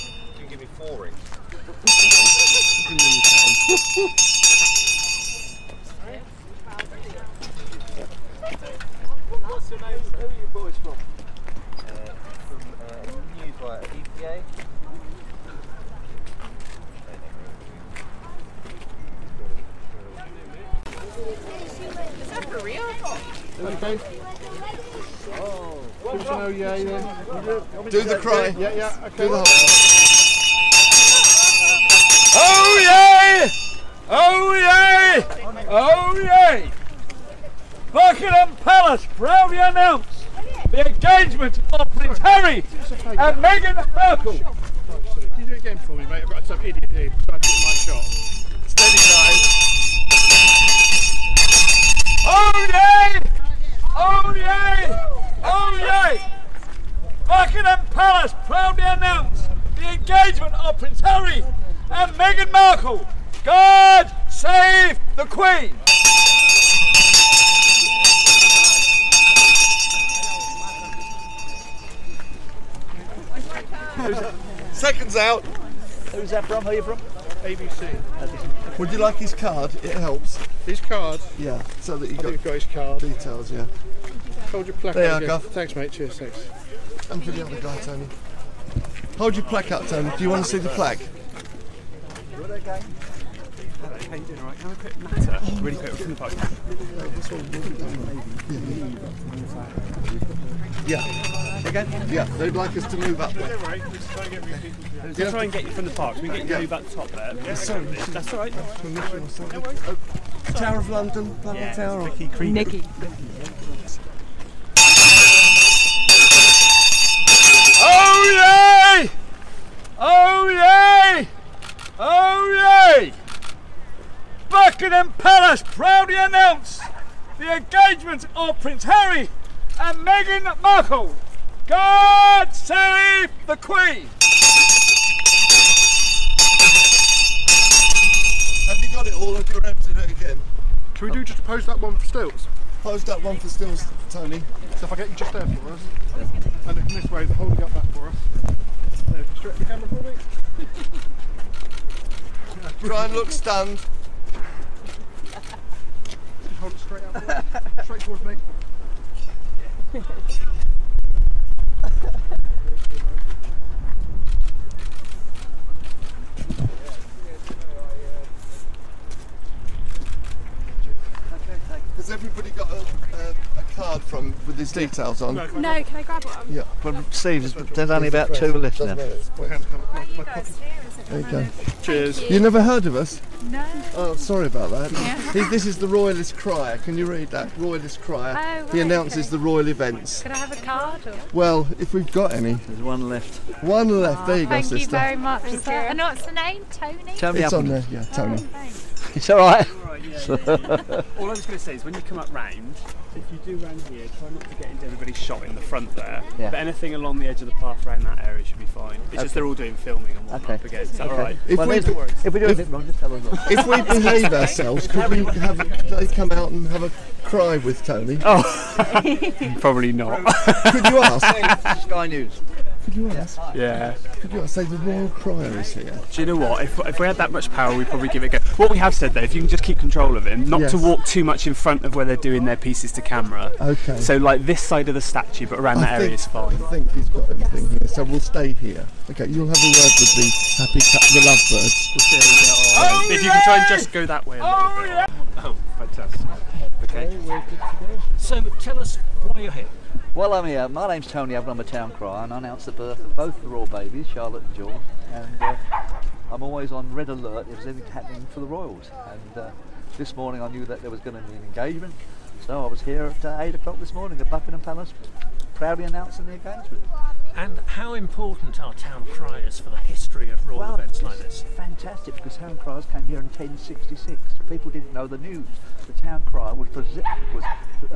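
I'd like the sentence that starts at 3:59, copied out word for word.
Okay, you'll have a word with the happy cat, the lovebirds.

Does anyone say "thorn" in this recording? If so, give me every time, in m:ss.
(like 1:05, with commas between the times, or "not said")
not said.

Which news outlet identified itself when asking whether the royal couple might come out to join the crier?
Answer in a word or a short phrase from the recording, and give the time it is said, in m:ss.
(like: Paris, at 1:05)
Sky News, at 3:41.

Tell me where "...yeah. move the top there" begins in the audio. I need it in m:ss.
1:46.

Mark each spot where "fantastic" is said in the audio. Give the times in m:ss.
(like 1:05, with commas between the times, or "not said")
4:05, 4:31.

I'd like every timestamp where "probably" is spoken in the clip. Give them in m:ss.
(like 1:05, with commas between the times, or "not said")
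3:39, 3:47.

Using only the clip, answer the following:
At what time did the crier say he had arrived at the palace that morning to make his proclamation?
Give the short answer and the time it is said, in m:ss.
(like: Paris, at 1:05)
8 o'clock, at 4:23.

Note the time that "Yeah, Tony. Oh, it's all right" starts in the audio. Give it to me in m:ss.
3:17.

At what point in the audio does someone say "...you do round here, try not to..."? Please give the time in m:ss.
3:23.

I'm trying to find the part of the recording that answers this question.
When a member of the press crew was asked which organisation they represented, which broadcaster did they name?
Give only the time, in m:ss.
1:17.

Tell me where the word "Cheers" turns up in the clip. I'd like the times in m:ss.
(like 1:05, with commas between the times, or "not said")
1:25, 3:01.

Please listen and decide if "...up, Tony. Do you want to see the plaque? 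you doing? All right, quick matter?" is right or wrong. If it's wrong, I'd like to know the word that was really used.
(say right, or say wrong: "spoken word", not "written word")
right.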